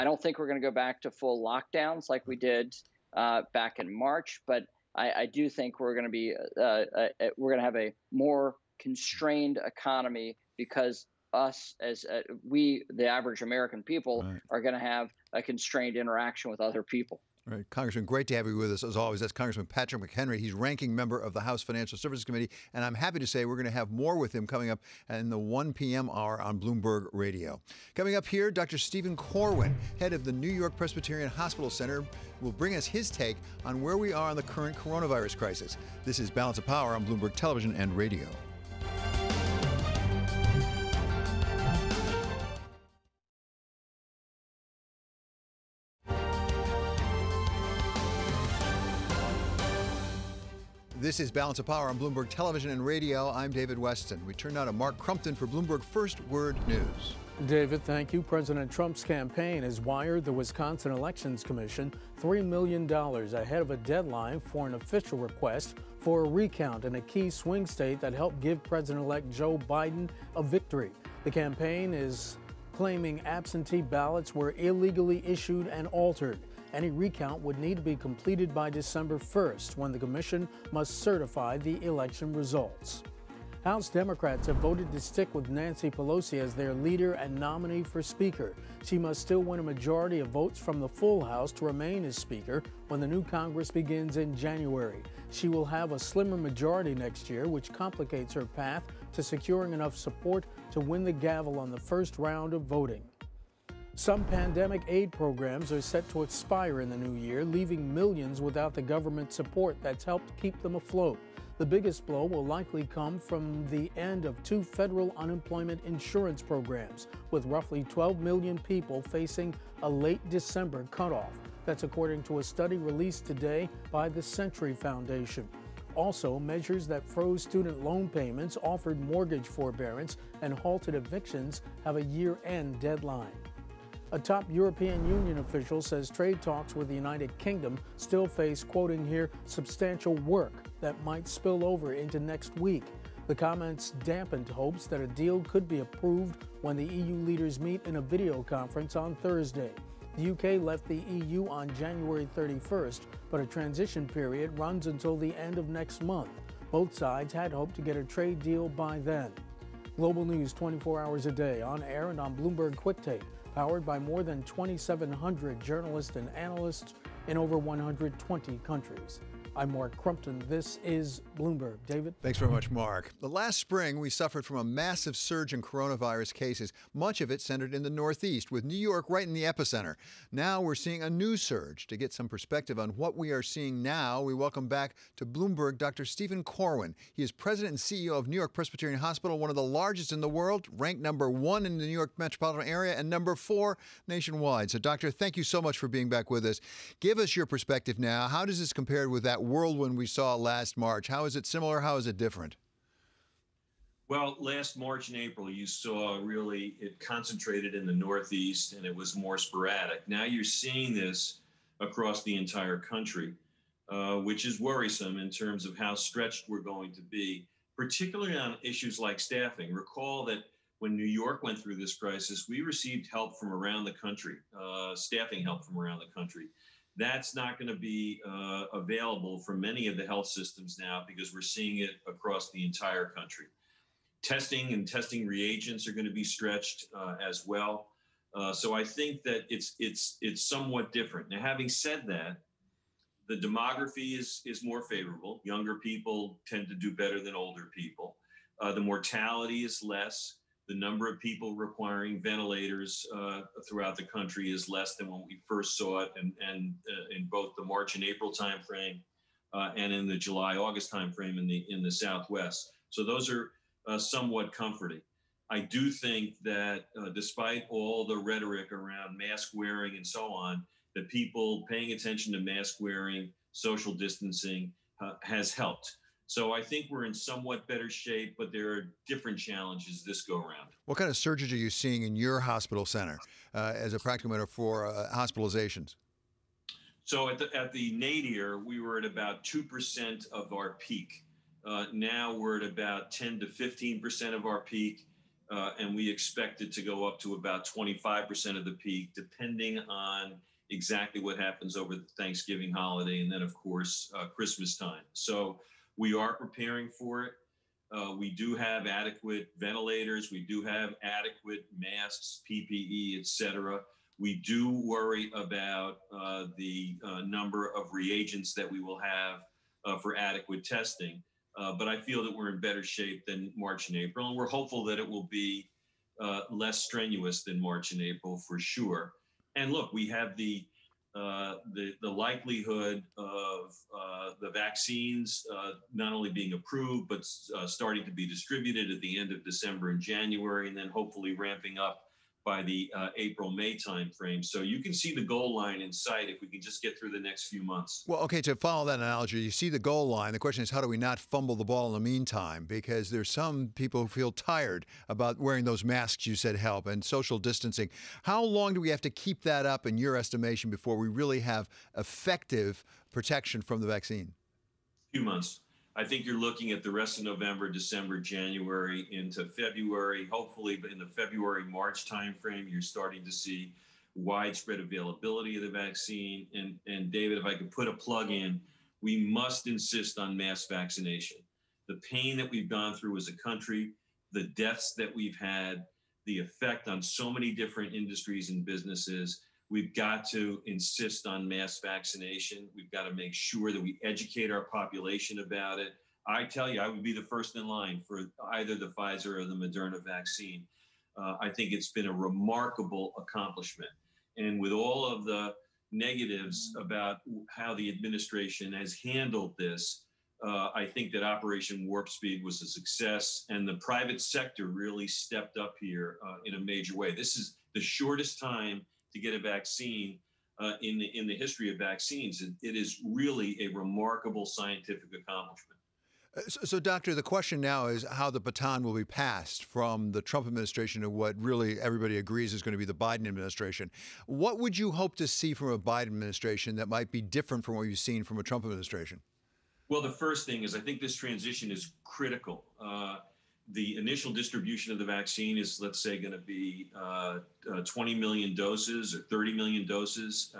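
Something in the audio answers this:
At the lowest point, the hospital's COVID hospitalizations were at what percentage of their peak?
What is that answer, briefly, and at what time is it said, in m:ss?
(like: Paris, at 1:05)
2%, at 4:49.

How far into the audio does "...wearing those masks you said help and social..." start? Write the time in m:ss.
5:55.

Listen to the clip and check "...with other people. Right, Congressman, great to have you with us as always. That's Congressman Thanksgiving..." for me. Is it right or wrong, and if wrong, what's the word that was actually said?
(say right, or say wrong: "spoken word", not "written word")
wrong: "Patrick", not "Thanksgiving".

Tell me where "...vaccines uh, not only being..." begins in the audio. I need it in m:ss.
5:34.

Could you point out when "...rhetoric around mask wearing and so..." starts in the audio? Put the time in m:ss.
4:28.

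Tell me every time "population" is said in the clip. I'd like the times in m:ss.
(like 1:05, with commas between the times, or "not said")
6:34.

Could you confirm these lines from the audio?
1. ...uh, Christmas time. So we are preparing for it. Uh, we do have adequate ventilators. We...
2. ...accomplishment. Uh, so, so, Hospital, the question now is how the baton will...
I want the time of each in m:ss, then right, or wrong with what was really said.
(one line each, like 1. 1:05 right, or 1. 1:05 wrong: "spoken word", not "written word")
1. 5:04 right
2. 7:05 wrong: "Doctor", not "Hospital".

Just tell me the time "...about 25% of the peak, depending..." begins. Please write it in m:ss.
4:57.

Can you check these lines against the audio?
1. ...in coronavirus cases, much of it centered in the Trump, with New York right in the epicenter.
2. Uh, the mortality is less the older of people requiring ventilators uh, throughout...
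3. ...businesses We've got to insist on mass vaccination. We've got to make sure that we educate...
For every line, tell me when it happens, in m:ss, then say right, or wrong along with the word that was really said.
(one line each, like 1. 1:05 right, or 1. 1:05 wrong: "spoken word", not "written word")
1. 2:55 wrong: "Northeast", not "Trump"
2. 4:08 wrong: "number", not "older"
3. 6:28 right.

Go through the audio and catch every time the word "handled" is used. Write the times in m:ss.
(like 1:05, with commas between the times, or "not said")
6:49.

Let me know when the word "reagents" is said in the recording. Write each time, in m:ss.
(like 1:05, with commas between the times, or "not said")
3:55, 5:17.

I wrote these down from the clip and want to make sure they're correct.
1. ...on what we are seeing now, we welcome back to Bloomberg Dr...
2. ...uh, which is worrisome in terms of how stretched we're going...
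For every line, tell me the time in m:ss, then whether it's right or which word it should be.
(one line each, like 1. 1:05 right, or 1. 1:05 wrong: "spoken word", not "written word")
1. 3:02 right
2. 3:33 right.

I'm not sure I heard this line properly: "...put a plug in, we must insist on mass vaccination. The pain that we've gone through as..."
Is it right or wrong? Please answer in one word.
right.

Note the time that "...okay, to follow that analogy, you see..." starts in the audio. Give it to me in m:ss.
5:48.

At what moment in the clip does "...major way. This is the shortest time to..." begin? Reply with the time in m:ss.
6:56.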